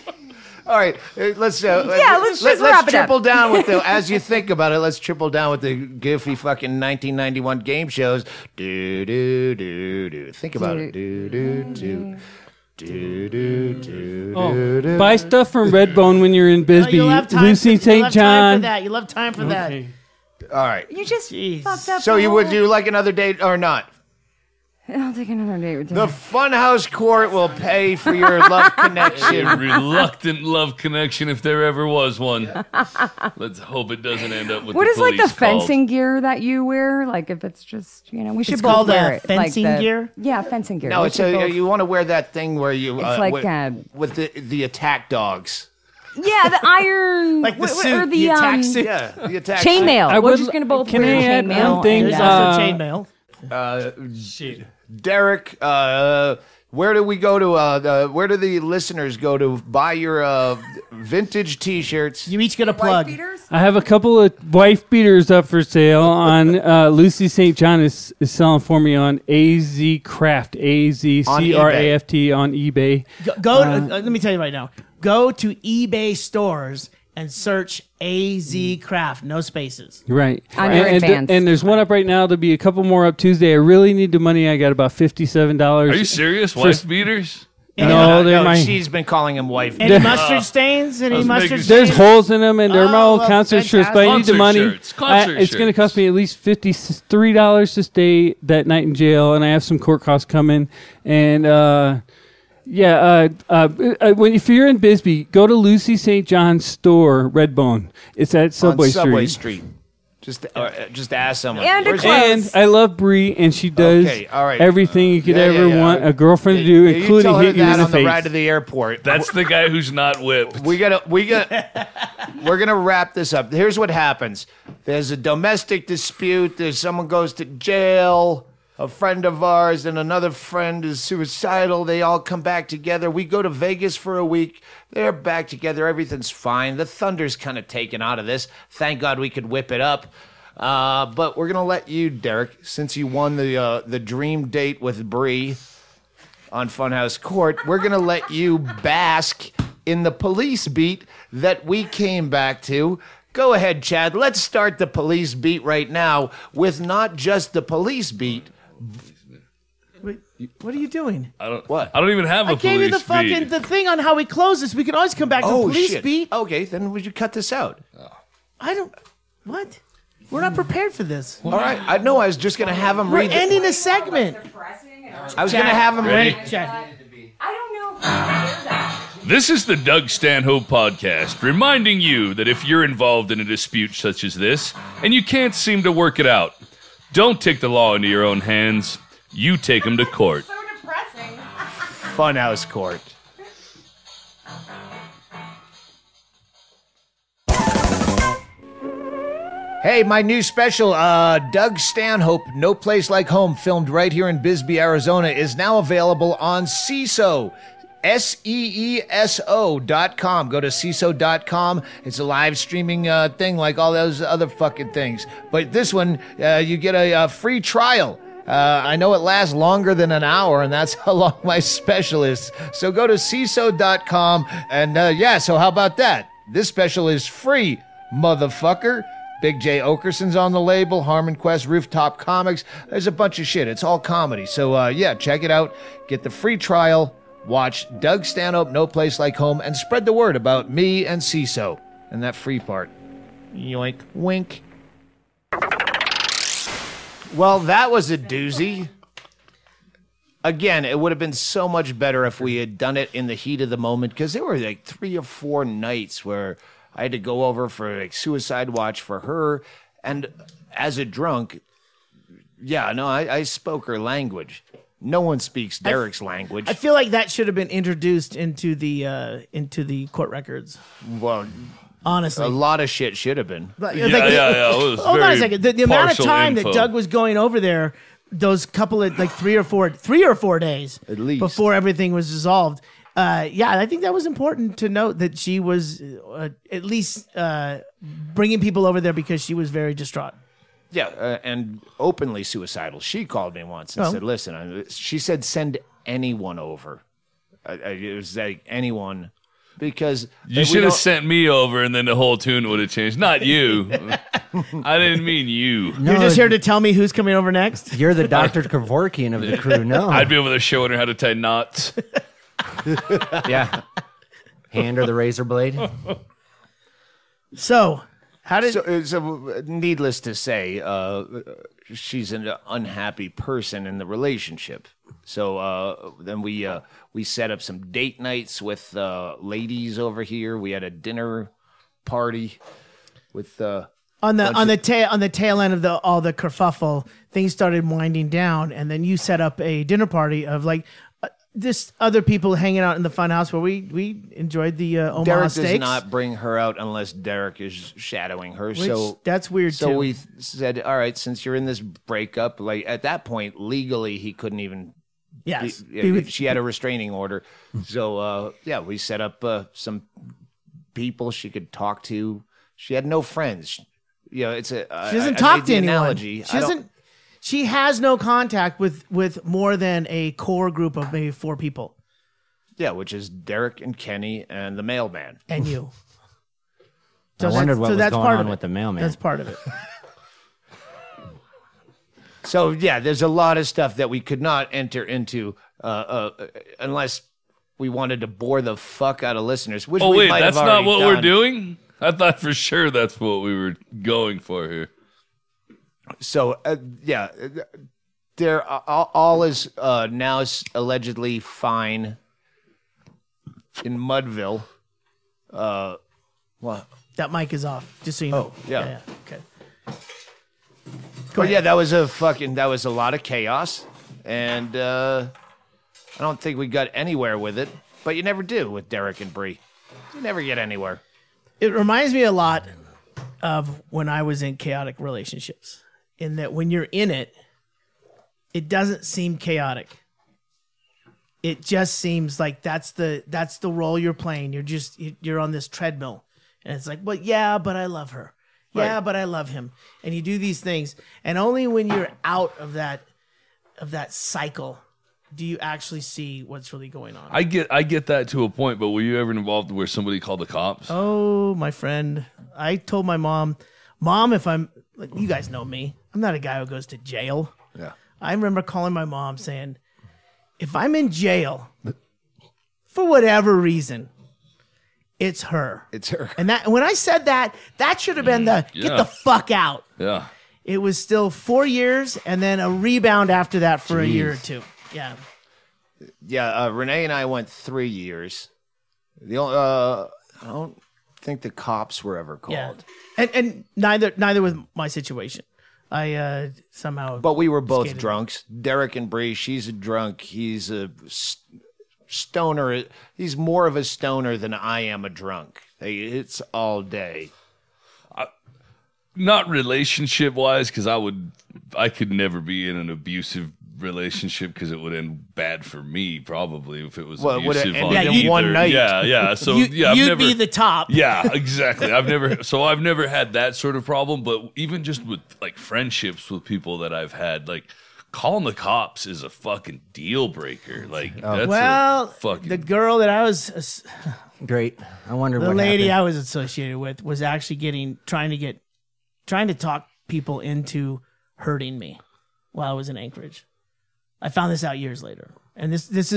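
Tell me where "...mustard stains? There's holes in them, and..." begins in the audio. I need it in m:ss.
1:31.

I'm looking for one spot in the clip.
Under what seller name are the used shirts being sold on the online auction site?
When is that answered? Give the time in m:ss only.
1:09.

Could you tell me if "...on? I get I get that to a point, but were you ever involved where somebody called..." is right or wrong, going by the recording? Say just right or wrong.
right.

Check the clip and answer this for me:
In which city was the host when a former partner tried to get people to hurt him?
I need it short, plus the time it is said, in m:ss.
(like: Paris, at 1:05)
Anchorage, at 8:52.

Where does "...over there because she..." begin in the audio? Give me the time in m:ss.
4:48.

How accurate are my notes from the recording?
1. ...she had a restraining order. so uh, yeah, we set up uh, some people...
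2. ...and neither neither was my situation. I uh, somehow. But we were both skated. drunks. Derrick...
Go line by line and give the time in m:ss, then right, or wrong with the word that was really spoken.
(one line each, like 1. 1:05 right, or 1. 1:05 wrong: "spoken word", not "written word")
1. 5:56 right
2. 8:03 right.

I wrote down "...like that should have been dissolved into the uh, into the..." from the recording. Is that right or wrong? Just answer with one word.
wrong.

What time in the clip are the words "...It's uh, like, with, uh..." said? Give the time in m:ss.
0:42.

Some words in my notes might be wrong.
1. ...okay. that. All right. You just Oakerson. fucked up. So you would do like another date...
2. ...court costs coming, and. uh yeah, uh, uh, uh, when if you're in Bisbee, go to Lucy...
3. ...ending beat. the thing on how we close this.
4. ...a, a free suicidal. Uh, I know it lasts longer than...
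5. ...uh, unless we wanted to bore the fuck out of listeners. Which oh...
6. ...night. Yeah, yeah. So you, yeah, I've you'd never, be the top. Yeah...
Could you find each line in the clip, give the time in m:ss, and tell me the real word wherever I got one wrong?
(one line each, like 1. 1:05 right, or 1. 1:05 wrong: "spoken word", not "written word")
1. 0:19 wrong: "Jeez", not "Oakerson"
2. 1:39 right
3. 2:42 wrong: "fucking", not "ending"
4. 3:36 wrong: "trial", not "suicidal"
5. 6:25 right
6. 8:28 right.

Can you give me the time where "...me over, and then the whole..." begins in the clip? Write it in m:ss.
5:01.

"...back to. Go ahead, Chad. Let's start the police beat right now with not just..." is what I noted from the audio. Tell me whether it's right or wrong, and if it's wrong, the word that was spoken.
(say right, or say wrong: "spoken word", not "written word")
right.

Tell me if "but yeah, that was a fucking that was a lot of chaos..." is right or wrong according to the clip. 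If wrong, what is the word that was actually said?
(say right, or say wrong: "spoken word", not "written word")
right.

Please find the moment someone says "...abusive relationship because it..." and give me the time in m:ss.
8:22.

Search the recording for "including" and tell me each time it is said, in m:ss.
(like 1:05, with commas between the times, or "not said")
1:56.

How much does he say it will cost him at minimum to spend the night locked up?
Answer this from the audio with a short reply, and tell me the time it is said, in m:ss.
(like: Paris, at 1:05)
$53, at 1:36.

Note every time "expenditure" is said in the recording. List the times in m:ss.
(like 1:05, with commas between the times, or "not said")
not said.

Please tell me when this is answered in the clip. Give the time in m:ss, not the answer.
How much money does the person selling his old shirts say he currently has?
1:24.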